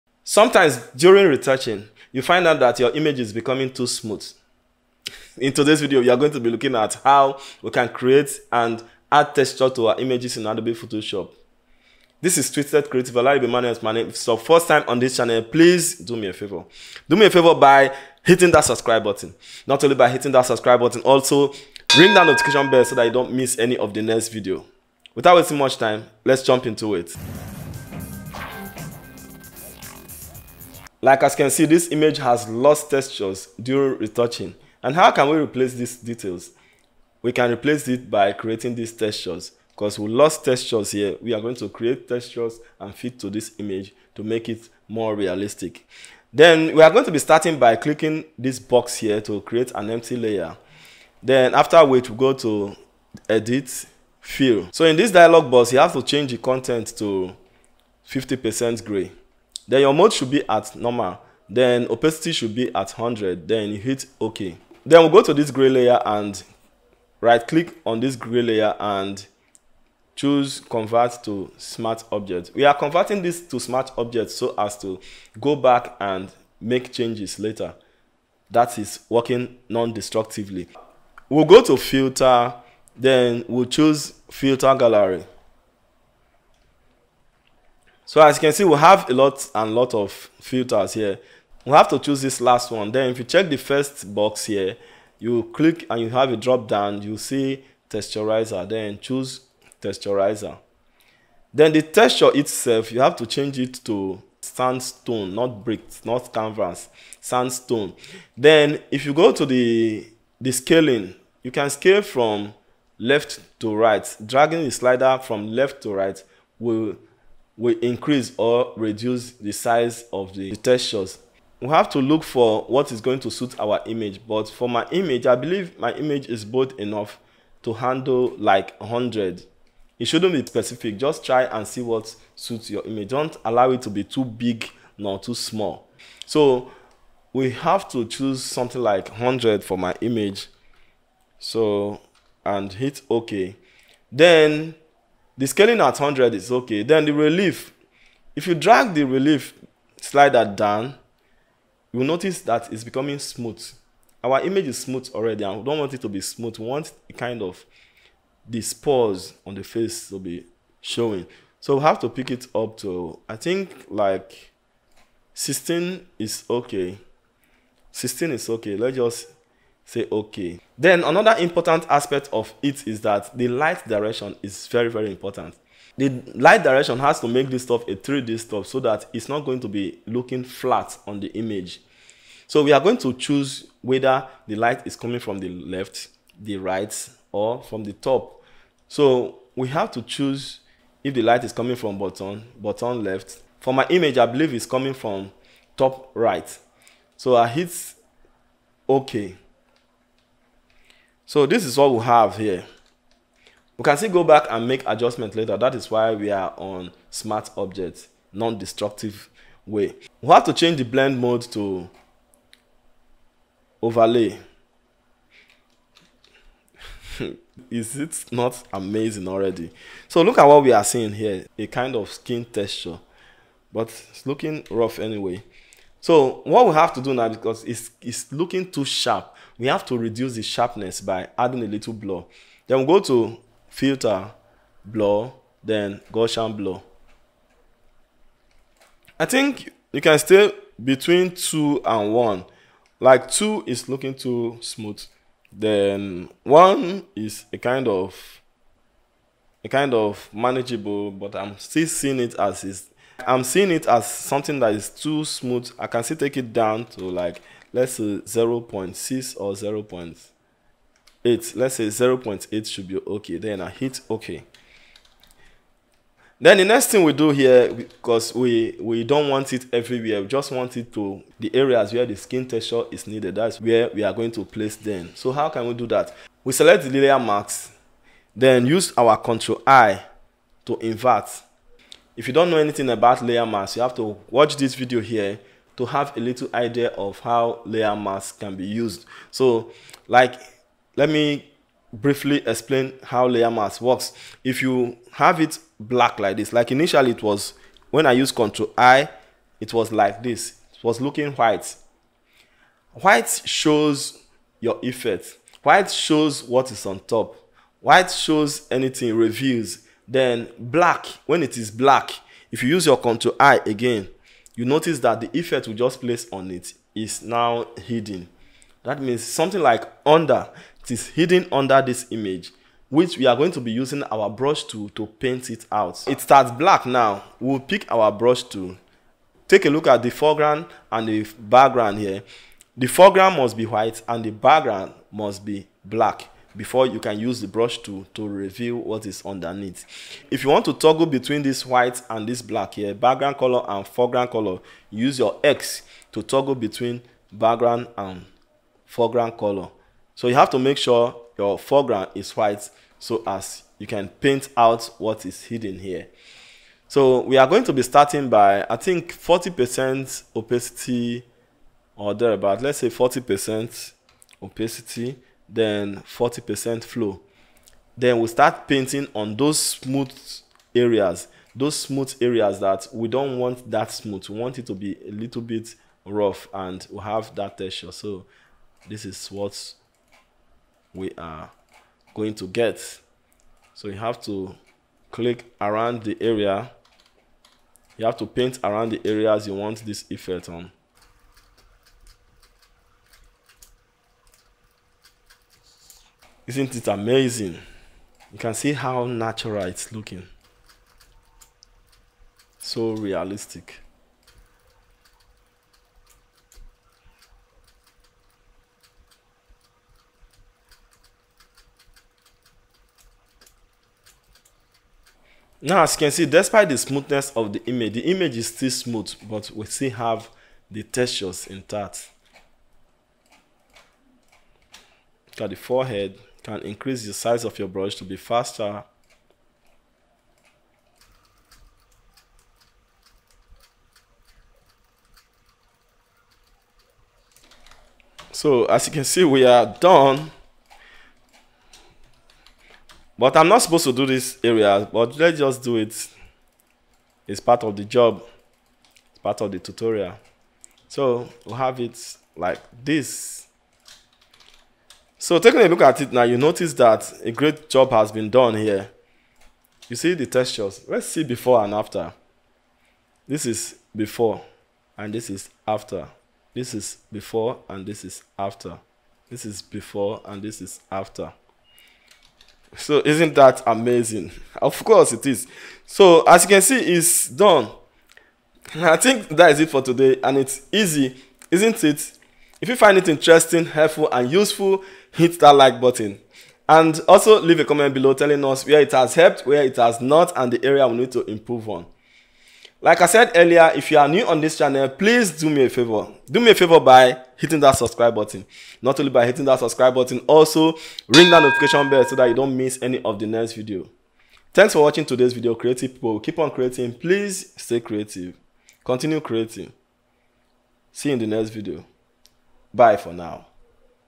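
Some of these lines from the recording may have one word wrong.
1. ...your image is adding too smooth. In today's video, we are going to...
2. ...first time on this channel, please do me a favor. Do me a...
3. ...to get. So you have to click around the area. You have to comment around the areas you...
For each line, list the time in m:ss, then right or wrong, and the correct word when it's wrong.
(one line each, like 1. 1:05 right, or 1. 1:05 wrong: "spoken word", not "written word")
1. 0:02 wrong: "becoming", not "adding"
2. 0:14 right
3. 6:22 wrong: "paint", not "comment".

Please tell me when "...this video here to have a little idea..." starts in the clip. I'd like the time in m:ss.
4:44.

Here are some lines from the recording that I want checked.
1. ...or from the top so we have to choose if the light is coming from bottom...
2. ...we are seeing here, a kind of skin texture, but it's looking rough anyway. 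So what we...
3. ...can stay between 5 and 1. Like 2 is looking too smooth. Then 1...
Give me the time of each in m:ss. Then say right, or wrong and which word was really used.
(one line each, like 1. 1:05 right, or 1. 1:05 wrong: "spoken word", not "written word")
1. 3:07 right
2. 3:40 right
3. 4:00 wrong: "2", not "5".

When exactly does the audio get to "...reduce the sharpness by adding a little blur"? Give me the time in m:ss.
3:49.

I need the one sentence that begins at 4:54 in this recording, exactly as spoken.
If you have it black like this, like initially it was, when I used Ctrl I, it was like this.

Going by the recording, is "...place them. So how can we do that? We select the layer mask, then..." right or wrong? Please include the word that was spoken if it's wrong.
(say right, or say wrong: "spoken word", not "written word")
right.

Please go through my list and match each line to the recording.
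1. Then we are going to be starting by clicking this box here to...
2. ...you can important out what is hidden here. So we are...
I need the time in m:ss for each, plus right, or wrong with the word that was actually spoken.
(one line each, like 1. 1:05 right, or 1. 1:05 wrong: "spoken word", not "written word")
1. 0:46 right
2. 5:53 wrong: "paint", not "important".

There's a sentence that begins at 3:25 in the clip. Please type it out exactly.
That is why we are on smart objects, non-destructive way.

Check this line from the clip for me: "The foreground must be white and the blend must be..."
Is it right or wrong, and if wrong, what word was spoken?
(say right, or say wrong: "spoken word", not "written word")
wrong: "background", not "blend".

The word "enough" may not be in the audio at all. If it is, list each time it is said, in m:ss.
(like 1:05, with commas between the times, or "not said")
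2:06.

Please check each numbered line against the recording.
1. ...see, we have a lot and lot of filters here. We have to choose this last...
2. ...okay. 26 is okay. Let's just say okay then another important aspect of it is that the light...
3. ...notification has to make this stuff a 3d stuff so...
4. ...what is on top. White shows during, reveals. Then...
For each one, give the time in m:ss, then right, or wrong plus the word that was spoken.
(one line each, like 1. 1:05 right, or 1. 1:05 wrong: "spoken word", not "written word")
1. 1:28 right
2. 2:46 wrong: "16", not "26"
3. 2:56 wrong: "direction", not "notification"
4. 5:06 wrong: "anything", not "during".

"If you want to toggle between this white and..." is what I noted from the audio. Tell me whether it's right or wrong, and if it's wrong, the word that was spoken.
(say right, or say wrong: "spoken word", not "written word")
right.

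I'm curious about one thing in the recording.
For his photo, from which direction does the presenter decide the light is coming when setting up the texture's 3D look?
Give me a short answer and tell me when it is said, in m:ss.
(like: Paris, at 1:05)
top right, at 3:15.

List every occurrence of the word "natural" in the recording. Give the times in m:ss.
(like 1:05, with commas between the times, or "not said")
6:39.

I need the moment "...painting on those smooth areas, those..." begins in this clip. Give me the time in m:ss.
6:08.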